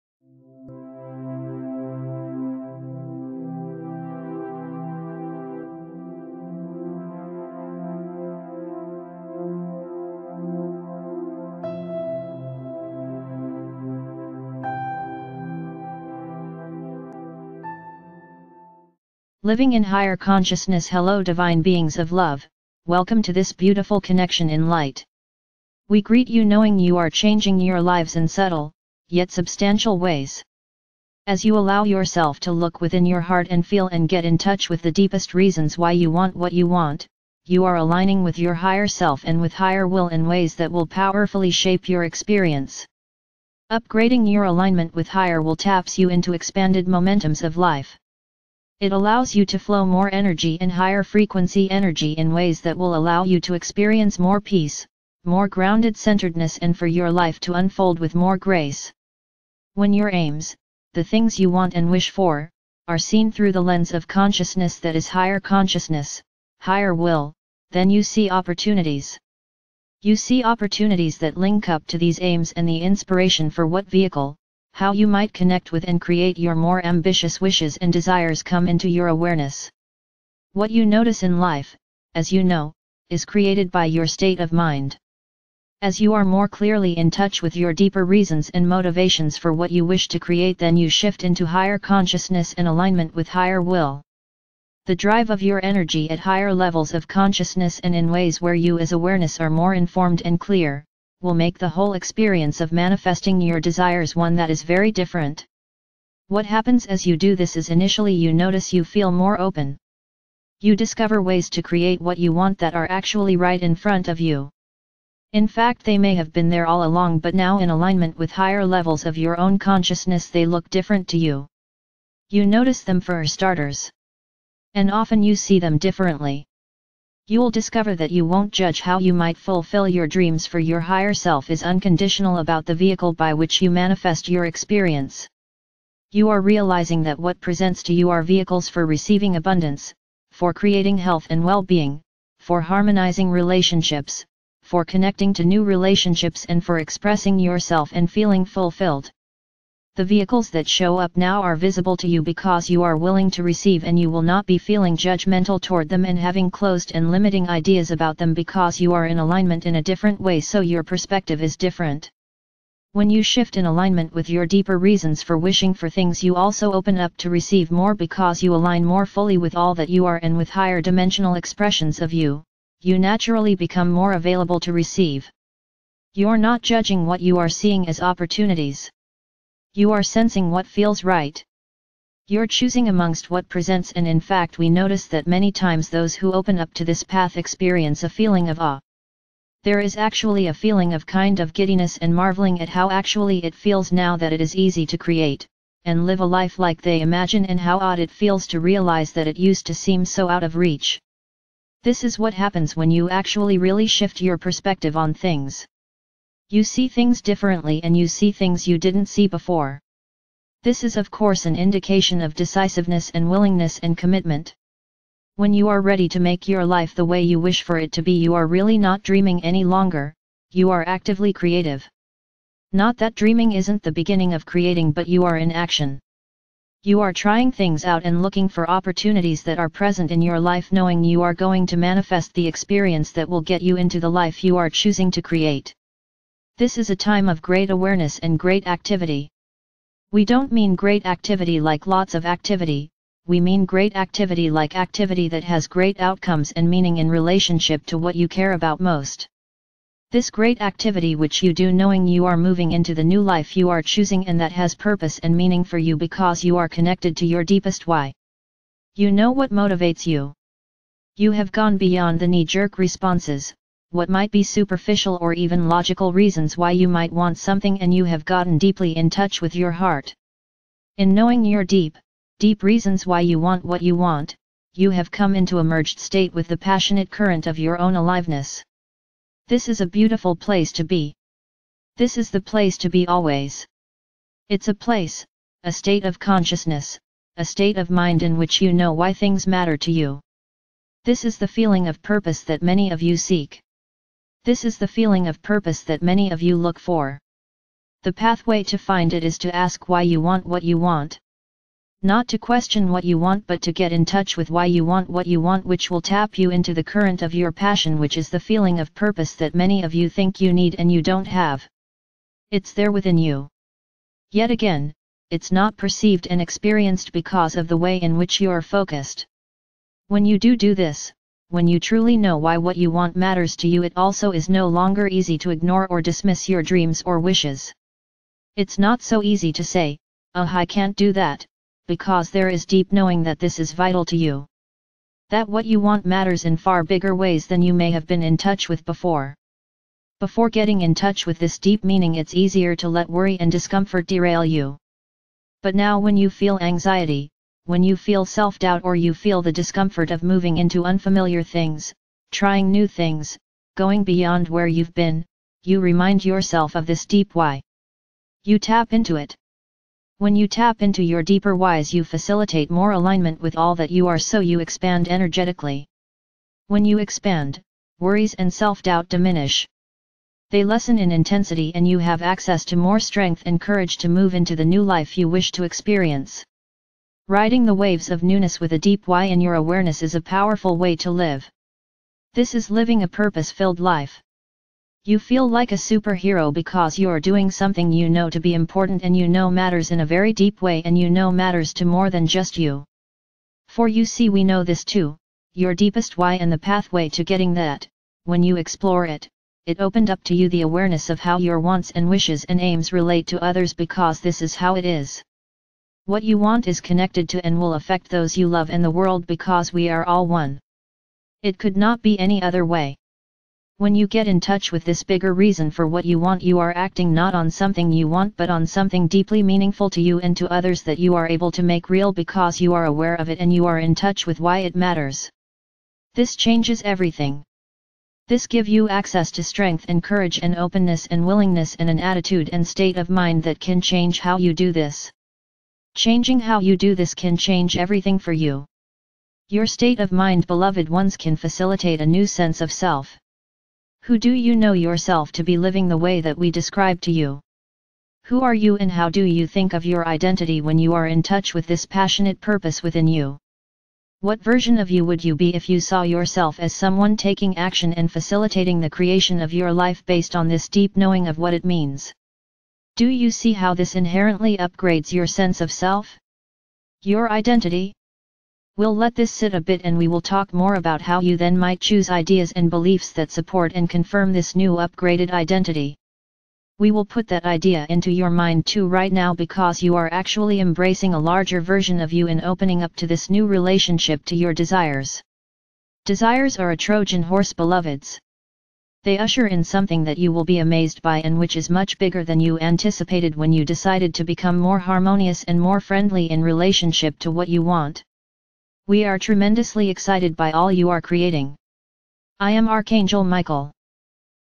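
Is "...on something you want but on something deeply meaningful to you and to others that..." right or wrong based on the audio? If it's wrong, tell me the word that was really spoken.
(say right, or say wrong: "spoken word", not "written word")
right.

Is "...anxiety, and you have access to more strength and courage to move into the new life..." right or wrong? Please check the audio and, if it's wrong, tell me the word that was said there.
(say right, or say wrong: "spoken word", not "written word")
wrong: "intensity", not "anxiety".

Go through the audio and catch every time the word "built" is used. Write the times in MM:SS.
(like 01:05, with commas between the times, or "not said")
not said.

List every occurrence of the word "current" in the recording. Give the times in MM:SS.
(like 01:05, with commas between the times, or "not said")
04:37, 05:06.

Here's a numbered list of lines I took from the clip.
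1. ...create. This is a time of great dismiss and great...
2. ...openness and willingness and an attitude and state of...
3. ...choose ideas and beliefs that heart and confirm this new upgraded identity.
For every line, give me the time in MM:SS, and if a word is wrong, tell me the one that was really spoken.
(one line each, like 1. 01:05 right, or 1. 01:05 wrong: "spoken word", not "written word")
1. 03:55 wrong: "awareness", not "dismiss"
2. 07:10 right
3. 07:51 wrong: "support", not "heart".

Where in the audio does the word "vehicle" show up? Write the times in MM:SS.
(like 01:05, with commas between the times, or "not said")
01:13, 02:12, 02:18, 02:30.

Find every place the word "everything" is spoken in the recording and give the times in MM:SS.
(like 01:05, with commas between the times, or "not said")
07:06, 07:17.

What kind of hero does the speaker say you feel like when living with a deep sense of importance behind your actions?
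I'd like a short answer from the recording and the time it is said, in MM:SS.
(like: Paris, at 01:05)
Superhero, at 06:25.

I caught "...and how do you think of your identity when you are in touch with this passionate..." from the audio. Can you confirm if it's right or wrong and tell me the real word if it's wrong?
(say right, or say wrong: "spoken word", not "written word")
right.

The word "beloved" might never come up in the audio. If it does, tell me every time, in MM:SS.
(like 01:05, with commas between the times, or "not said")
07:20, 08:07.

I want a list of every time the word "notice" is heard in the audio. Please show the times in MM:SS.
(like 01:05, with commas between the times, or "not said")
01:20, 01:48, 02:02, 03:04.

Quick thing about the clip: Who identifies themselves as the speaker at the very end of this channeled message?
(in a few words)
Archangel Michael.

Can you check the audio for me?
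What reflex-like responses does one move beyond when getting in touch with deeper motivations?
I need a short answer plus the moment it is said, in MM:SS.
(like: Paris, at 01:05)
Knee jerk responses, at 04:22.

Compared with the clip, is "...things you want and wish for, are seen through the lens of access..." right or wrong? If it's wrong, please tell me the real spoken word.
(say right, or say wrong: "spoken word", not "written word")
wrong: "consciousness", not "access".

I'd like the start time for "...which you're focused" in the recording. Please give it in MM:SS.
05:18.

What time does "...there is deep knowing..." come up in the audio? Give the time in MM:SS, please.
05:32.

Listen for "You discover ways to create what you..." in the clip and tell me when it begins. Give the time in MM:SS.
01:50.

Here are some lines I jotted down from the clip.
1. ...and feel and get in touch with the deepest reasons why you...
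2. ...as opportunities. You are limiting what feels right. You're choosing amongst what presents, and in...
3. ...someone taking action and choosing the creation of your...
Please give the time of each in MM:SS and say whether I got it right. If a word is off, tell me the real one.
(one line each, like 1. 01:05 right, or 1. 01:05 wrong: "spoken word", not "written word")
1. 00:33 right
2. 02:57 wrong: "sensing", not "limiting"
3. 07:36 wrong: "facilitating", not "choosing".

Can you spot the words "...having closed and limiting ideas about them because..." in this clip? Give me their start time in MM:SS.
02:36.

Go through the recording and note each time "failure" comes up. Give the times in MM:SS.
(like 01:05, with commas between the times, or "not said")
not said.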